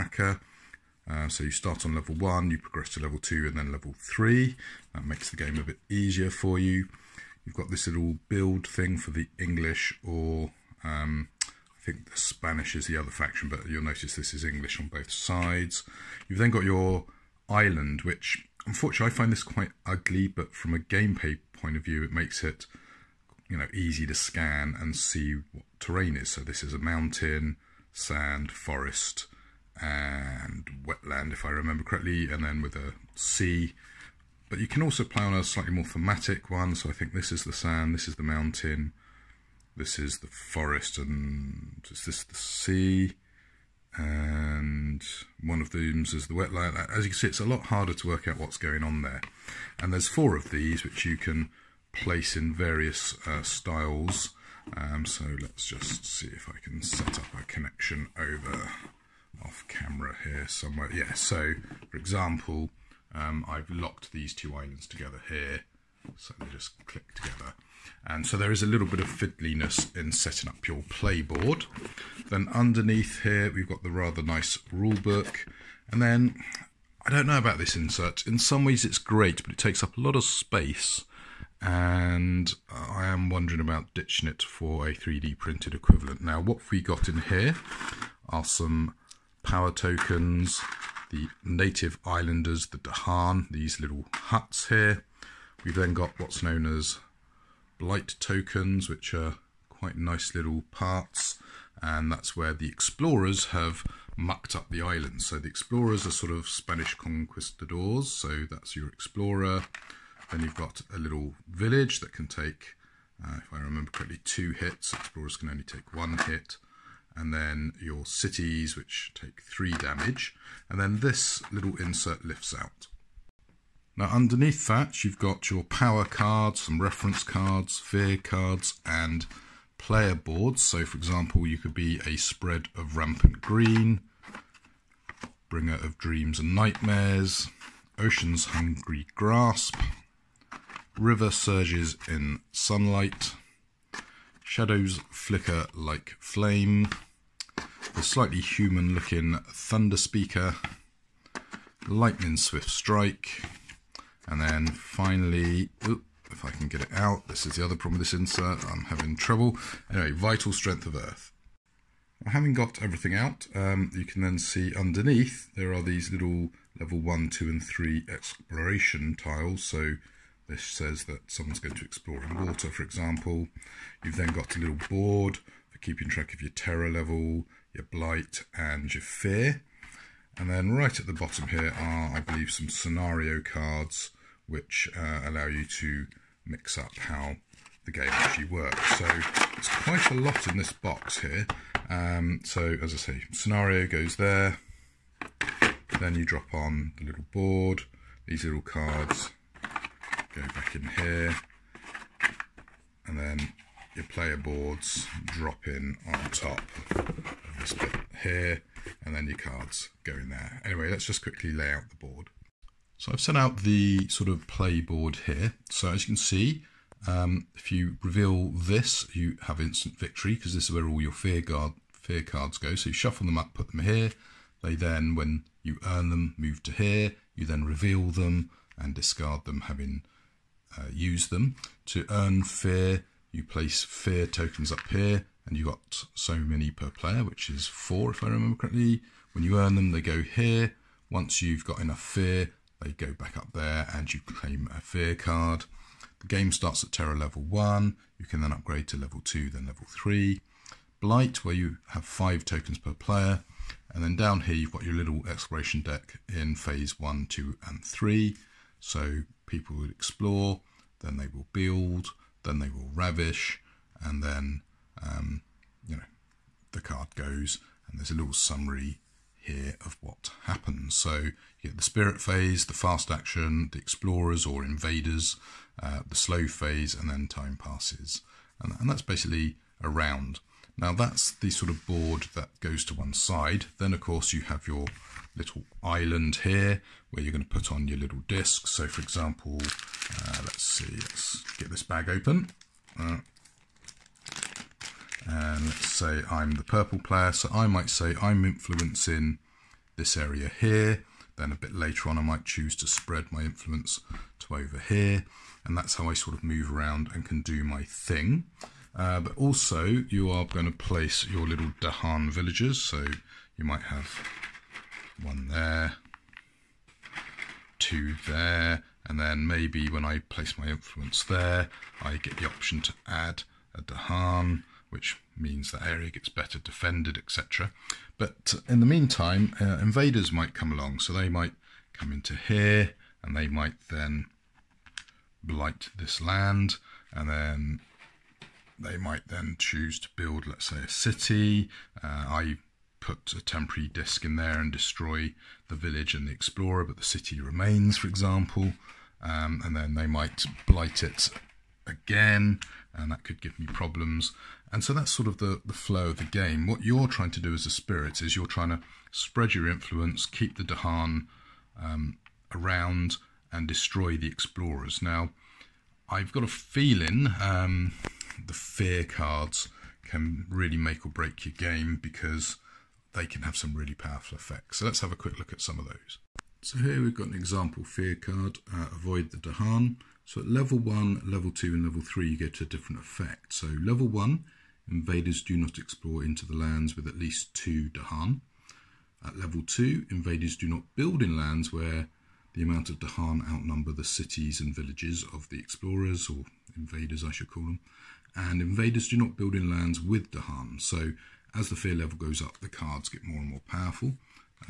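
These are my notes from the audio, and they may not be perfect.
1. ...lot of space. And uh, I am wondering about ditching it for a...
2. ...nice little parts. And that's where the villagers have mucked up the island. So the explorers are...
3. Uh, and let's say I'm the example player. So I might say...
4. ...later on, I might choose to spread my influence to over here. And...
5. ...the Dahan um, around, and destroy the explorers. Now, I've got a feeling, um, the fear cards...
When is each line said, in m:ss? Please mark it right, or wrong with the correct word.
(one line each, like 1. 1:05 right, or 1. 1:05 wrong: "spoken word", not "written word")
1. 1:20 right
2. 1:39 wrong: "explorers", not "villagers"
3. 4:52 wrong: "purple", not "example"
4. 5:01 right
5. 6:00 right.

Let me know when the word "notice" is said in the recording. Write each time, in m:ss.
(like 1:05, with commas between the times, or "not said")
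0:13.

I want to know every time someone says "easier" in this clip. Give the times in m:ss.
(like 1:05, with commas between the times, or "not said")
0:05.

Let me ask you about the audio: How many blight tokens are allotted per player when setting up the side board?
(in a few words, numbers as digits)
5.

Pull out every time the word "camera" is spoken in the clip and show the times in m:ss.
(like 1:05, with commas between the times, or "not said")
0:59.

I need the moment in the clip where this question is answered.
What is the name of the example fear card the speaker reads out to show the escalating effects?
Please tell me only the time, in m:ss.
6:18.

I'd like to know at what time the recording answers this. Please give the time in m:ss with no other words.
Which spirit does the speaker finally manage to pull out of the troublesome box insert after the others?
2:40.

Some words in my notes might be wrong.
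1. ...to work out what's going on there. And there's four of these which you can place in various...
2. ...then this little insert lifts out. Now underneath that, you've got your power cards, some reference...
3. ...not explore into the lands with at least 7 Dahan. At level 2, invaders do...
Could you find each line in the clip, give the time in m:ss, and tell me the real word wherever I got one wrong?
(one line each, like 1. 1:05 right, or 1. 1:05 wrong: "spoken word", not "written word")
1. 0:47 right
2. 2:00 right
3. 6:25 wrong: "2", not "7".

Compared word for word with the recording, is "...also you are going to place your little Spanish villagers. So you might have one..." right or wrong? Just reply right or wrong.
wrong.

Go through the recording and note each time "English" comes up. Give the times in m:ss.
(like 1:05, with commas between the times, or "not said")
0:09, 0:14.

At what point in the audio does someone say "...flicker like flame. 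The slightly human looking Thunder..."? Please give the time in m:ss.
2:25.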